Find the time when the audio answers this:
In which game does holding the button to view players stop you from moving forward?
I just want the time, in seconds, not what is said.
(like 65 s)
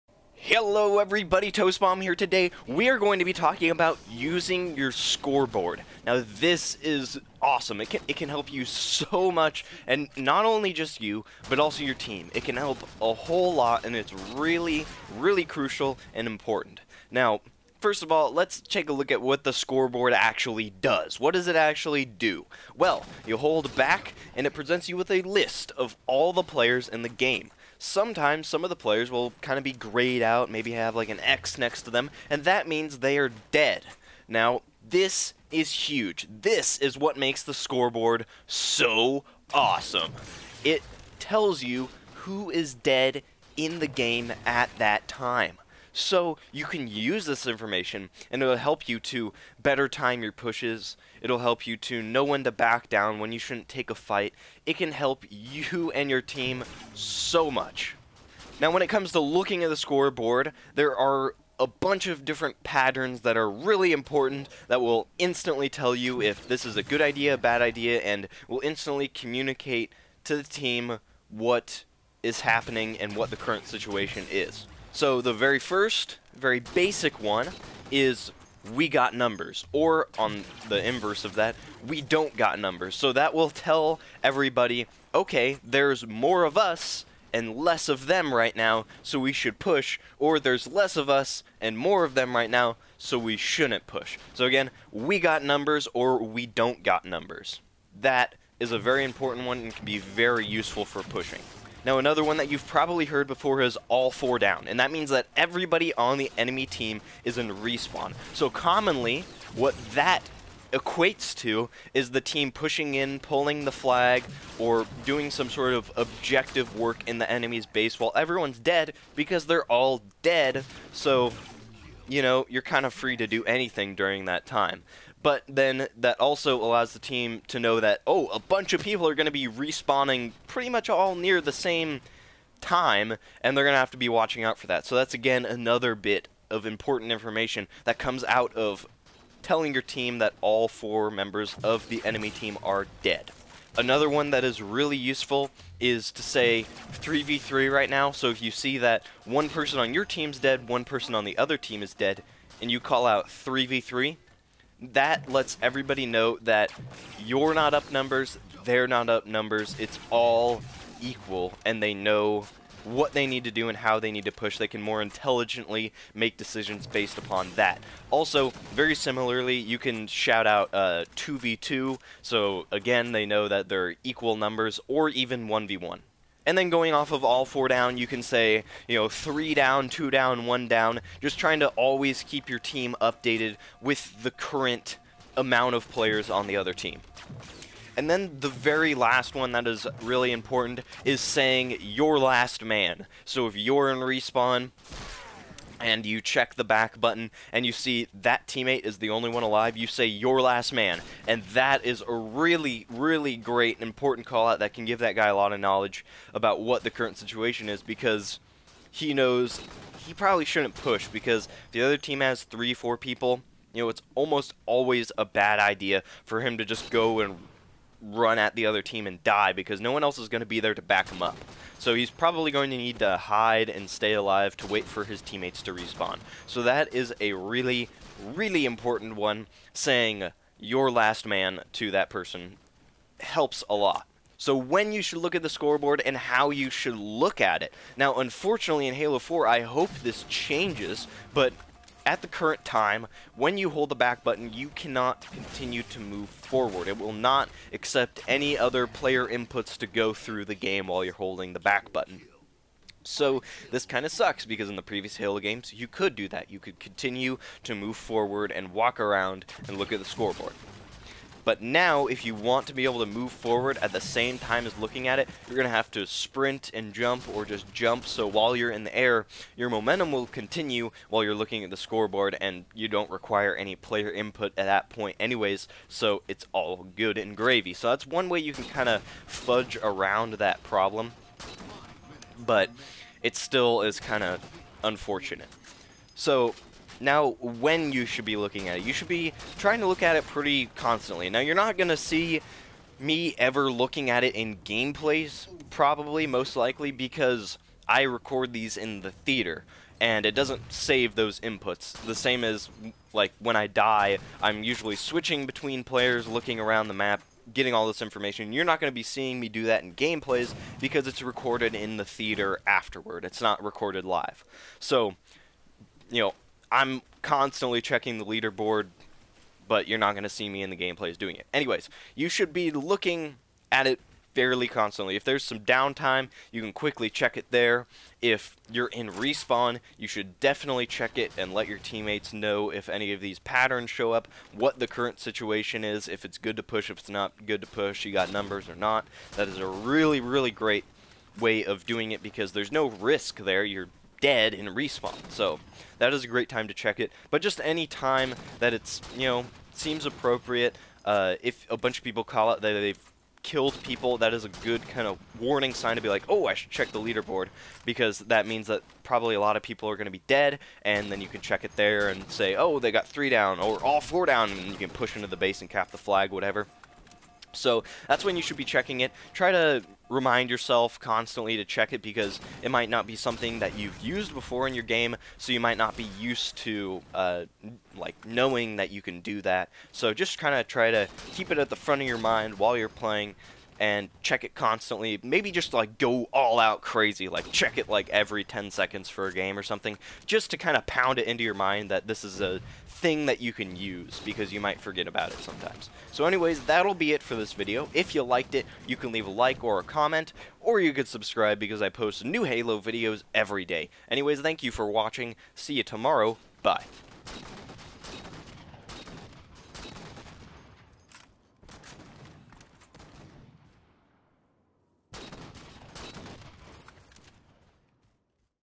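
238 s.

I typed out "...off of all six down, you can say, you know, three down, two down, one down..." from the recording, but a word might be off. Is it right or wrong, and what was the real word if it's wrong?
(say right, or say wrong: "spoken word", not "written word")
wrong: "four", not "six".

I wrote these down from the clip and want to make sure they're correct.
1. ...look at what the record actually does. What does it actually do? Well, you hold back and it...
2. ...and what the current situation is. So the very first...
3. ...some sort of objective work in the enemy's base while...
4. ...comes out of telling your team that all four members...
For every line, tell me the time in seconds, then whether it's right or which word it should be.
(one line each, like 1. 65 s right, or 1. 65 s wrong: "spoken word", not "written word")
1. 18 s wrong: "scoreboard", not "record"
2. 72 s right
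3. 115 s right
4. 137 s right.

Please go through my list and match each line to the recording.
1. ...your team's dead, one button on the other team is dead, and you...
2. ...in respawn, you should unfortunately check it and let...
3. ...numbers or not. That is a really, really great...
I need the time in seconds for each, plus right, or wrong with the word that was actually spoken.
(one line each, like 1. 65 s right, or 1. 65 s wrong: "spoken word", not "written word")
1. 149 s wrong: "person", not "button"
2. 328 s wrong: "definitely", not "unfortunately"
3. 338 s right.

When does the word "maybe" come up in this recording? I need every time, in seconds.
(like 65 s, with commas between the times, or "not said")
30 s, 385 s.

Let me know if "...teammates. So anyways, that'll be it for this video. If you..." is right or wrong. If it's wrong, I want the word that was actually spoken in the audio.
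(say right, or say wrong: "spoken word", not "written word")
wrong: "sometimes", not "teammates".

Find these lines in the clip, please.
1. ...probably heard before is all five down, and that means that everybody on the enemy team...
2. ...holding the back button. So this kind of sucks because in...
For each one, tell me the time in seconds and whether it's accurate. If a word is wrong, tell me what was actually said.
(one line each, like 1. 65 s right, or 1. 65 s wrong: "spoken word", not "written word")
1. 102 s wrong: "four", not "five"
2. 251 s right.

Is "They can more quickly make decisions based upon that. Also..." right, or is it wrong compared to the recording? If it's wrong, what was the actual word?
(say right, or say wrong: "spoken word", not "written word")
wrong: "intelligently", not "quickly".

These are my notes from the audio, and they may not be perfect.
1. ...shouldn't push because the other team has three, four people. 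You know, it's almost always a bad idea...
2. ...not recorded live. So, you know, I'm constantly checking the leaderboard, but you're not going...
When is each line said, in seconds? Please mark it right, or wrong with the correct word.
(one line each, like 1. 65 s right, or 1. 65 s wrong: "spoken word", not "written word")
1. 210 s right
2. 313 s right.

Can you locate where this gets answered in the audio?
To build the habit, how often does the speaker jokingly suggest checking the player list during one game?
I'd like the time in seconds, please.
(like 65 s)
388 s.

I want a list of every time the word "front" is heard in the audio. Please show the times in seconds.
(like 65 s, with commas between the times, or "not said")
381 s.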